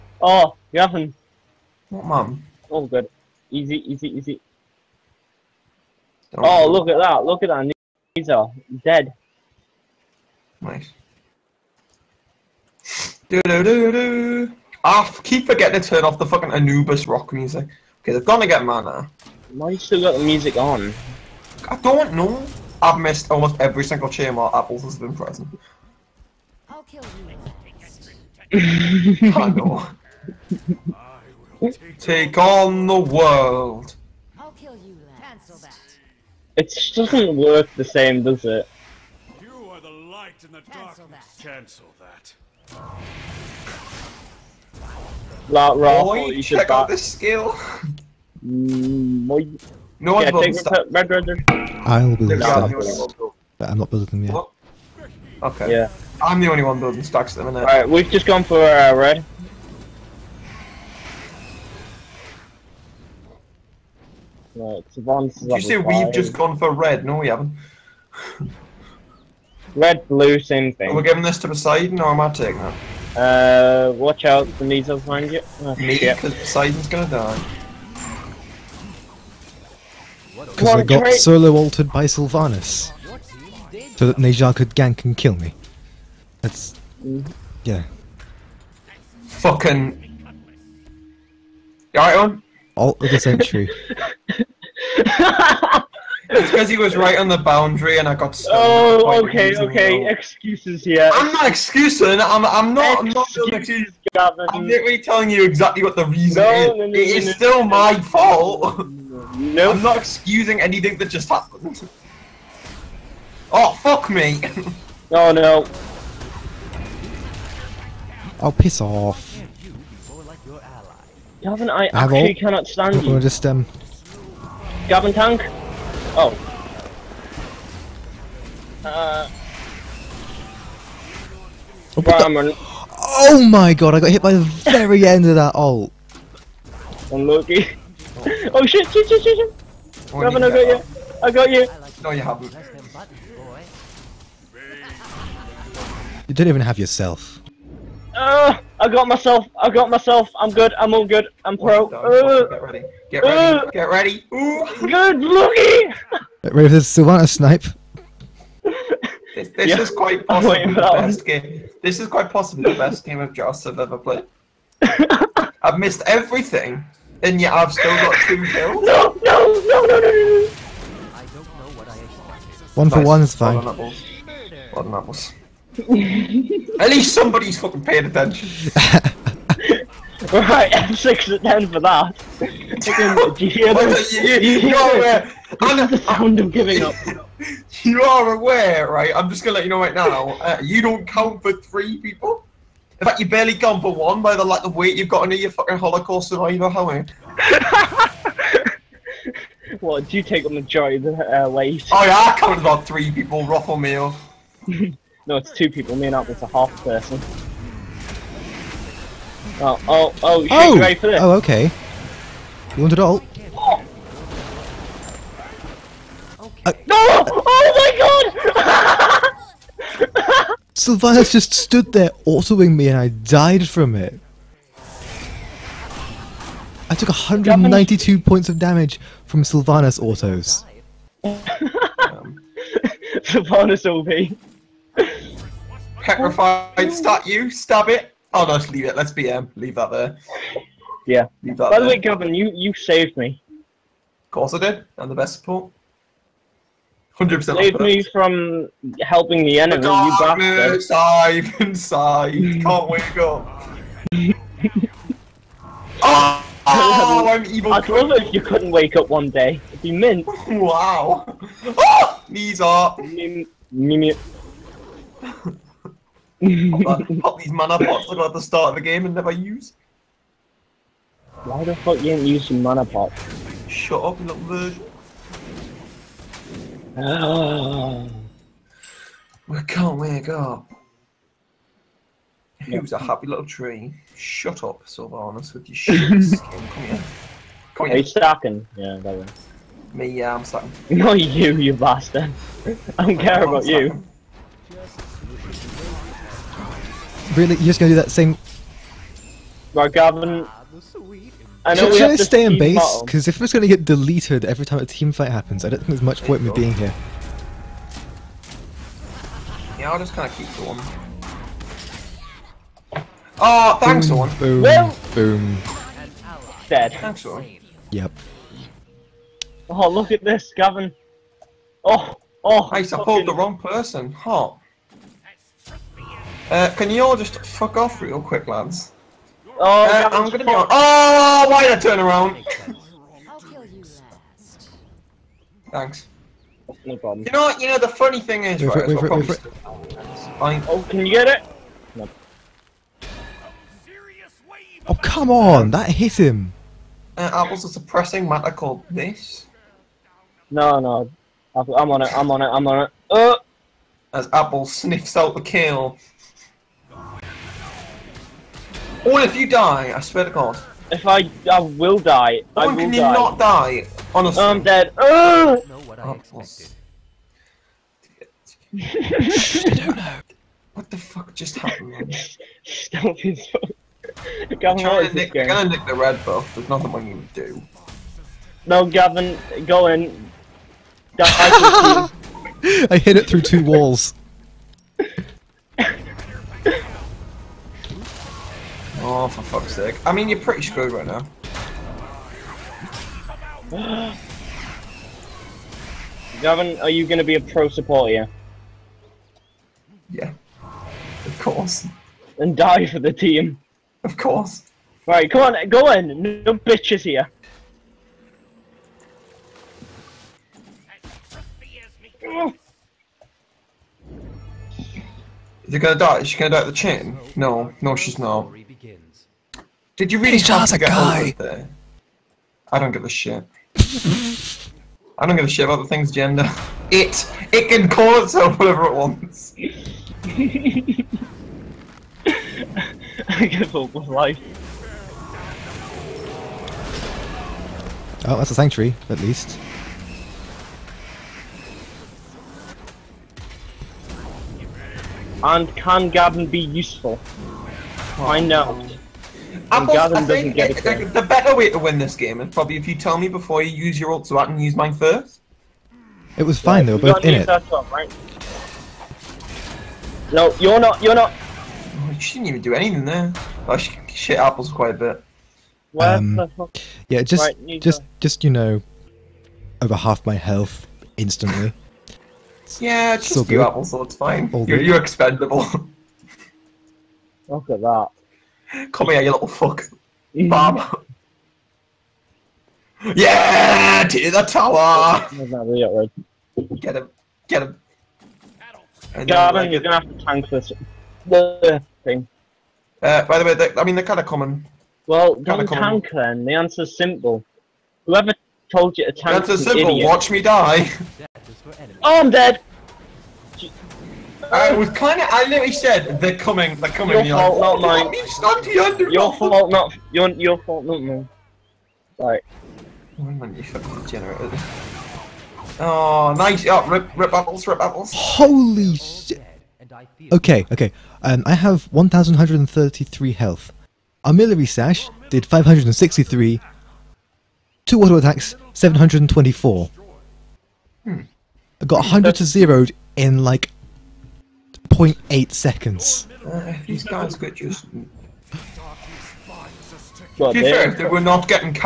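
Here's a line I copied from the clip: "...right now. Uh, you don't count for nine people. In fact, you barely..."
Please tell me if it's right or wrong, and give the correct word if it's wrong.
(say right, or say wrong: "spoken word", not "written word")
wrong: "three", not "nine".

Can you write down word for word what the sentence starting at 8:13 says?
Uh, by the way, I mean they're kind of common.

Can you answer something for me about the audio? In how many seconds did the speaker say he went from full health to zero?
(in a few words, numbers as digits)
0.8.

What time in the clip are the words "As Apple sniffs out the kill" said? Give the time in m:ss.
5:54.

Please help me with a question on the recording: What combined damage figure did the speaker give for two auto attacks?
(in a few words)
724.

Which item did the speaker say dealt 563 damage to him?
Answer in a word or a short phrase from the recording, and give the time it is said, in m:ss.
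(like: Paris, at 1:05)
Armillary Sash, at 8:44.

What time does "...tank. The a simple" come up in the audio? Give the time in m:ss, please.
8:19.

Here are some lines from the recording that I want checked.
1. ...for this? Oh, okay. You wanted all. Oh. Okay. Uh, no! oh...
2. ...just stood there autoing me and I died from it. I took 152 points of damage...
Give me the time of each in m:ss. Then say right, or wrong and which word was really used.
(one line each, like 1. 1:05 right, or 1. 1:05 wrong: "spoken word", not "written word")
1. 3:30 right
2. 3:41 wrong: "192", not "152".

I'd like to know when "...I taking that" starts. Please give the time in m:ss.
1:12.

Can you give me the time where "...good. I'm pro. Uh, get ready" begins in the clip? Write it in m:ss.
2:31.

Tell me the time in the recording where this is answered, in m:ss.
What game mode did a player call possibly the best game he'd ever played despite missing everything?
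2:43.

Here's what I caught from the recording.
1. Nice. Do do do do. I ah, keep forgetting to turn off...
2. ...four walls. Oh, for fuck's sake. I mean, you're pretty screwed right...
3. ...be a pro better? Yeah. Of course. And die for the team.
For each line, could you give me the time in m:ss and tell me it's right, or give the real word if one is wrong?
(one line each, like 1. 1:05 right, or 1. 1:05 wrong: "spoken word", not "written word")
1. 0:10 right
2. 6:23 wrong: "two", not "four"
3. 6:37 wrong: "supporter", not "better".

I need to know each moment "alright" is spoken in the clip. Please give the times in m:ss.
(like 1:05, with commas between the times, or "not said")
0:57, 1:31.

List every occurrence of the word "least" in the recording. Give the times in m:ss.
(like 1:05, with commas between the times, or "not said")
2:56, 7:19.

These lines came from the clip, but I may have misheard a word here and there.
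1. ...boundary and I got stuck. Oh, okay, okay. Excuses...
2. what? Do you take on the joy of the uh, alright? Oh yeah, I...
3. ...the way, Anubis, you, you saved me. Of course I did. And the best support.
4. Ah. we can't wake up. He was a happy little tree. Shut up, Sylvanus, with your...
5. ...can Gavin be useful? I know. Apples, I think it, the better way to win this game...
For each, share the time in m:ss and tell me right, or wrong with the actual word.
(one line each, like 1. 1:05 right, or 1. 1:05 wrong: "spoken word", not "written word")
1. 1:37 right
2. 3:19 wrong: "weight", not "alright"
3. 4:01 wrong: "Gavin", not "Anubis"
4. 4:38 right
5. 7:25 right.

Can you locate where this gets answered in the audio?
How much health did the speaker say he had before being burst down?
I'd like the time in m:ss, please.
8:41.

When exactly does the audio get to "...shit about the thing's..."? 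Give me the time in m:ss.
7:05.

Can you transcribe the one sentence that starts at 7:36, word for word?
It was fine yeah, though, both in it.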